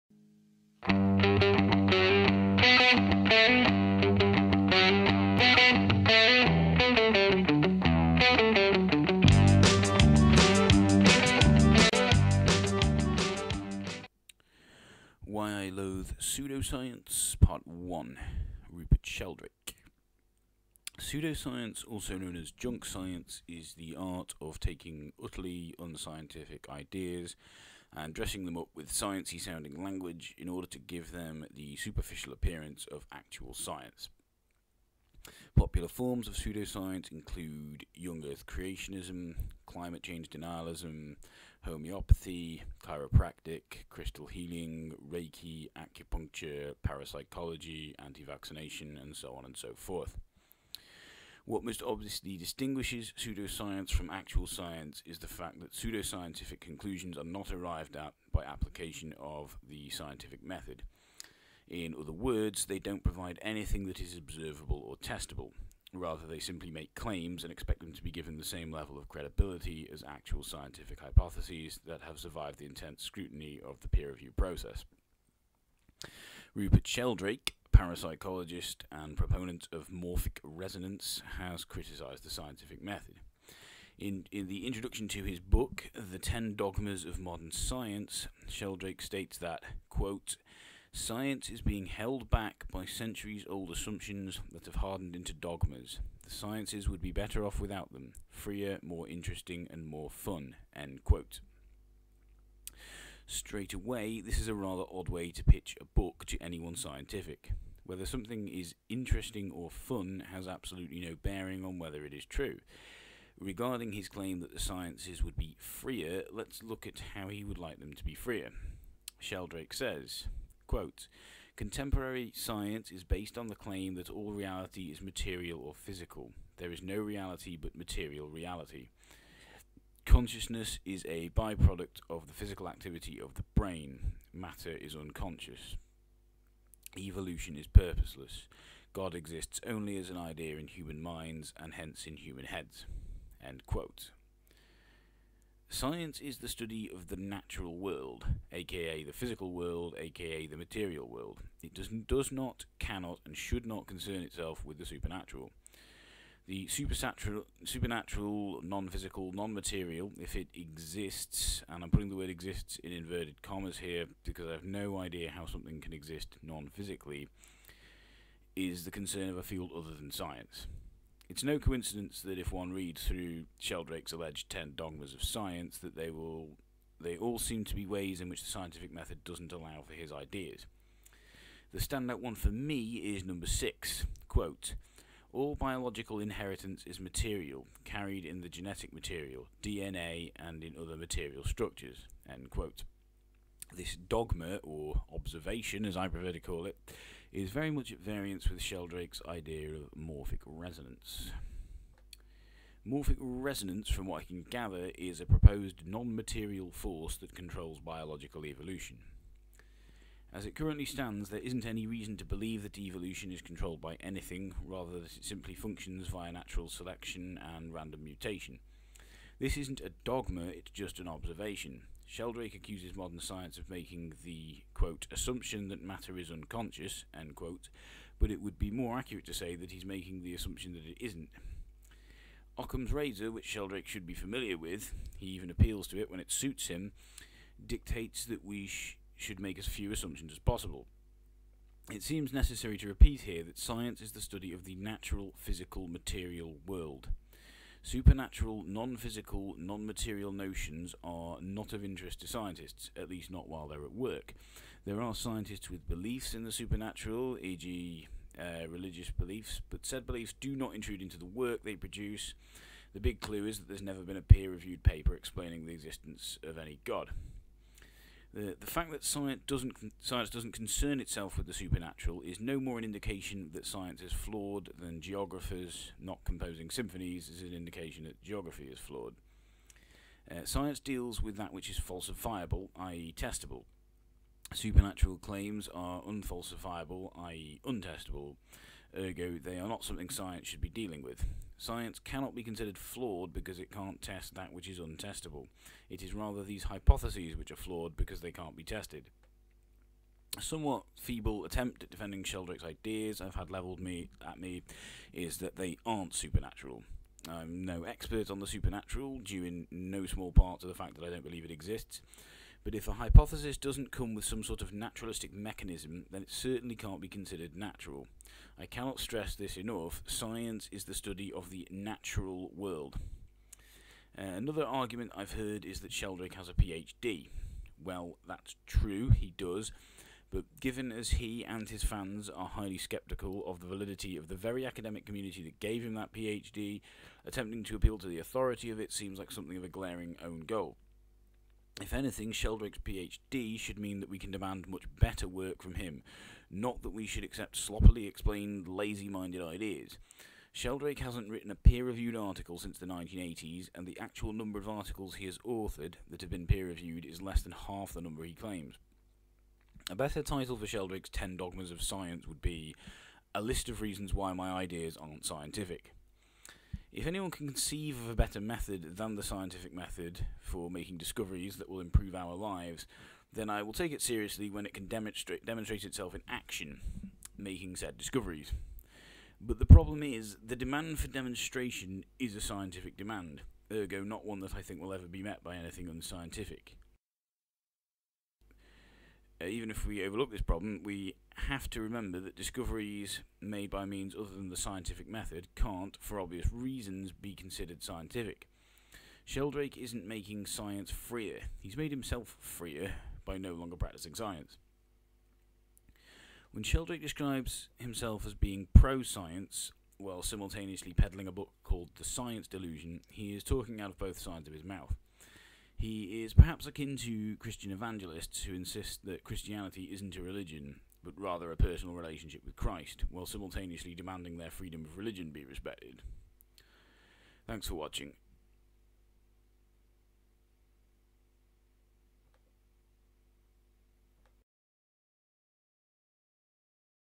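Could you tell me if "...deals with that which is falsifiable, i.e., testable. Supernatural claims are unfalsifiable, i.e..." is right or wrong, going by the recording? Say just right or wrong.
right.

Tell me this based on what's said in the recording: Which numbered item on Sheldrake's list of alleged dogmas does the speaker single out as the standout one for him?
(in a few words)
6.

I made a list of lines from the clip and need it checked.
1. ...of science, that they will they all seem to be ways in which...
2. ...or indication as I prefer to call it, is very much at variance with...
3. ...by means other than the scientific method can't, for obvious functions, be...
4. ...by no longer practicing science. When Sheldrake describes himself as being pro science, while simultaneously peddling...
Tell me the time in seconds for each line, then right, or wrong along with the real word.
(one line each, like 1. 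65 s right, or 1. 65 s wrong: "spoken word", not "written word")
1. 175 s right
2. 194 s wrong: "observation", not "indication"
3. 393 s wrong: "reasons", not "functions"
4. 403 s right.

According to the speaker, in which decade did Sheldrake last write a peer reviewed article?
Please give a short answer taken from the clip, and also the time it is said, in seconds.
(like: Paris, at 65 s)
1980s, at 352 s.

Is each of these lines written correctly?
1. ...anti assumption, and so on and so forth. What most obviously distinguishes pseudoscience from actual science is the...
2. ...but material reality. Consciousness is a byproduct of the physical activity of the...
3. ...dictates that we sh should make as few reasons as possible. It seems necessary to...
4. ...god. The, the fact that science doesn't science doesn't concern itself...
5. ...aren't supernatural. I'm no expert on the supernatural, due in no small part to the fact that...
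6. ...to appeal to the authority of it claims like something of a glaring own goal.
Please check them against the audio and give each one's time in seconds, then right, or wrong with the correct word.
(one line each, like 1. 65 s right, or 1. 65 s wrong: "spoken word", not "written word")
1. 47 s wrong: "vaccination", not "assumption"
2. 127 s right
3. 237 s wrong: "assumptions", not "reasons"
4. 266 s right
5. 305 s right
6. 337 s wrong: "seems", not "claims".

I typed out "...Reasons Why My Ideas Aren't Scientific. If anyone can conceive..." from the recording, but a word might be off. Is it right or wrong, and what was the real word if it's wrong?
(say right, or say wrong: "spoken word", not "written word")
right.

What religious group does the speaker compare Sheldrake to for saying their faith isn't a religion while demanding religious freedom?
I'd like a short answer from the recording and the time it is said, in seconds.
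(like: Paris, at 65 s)
Christian evangelists, at 417 s.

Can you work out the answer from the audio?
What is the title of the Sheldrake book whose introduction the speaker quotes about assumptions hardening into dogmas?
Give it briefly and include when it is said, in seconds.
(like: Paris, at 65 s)
The Ten Dogmas of Modern Science, at 85 s.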